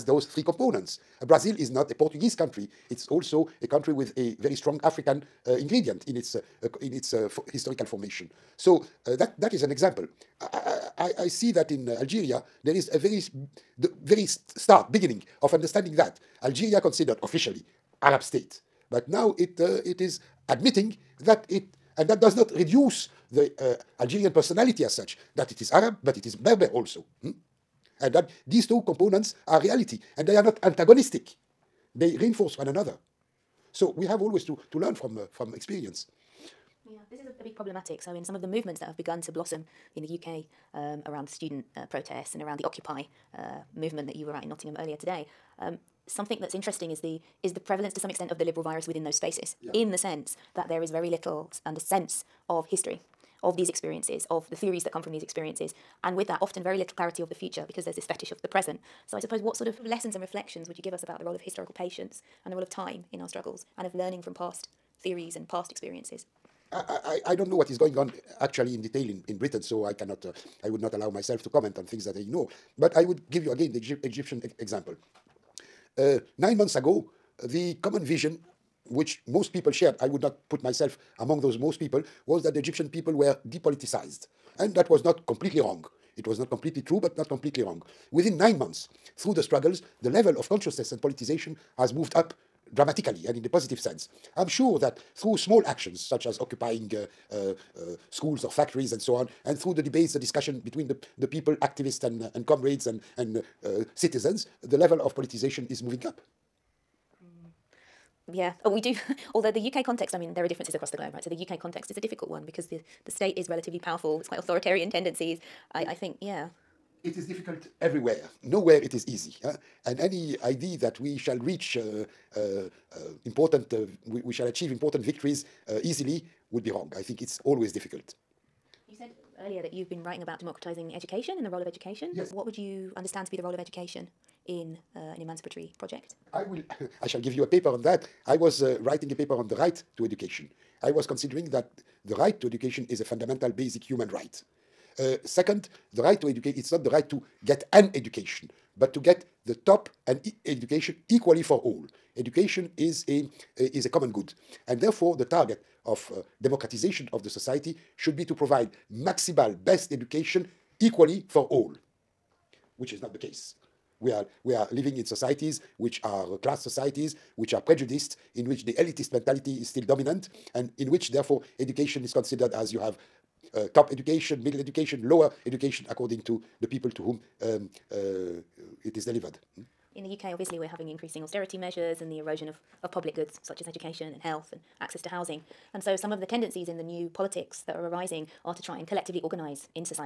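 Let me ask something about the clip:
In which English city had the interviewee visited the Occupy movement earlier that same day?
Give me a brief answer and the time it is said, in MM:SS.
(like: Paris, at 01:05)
Nottingham, at 00:44.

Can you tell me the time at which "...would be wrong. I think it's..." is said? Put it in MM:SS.
02:06.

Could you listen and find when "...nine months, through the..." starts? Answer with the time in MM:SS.
01:28.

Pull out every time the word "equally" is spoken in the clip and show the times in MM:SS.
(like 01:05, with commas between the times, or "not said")
02:31, 02:40.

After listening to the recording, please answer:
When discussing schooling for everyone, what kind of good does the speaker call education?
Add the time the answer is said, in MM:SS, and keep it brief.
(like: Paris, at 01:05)
a common good, at 02:33.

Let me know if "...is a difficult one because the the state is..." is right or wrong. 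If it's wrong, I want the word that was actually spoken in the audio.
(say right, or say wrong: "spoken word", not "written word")
right.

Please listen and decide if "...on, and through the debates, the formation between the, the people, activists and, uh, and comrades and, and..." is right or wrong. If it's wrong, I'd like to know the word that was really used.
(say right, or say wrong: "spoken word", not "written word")
wrong: "discussion", not "formation".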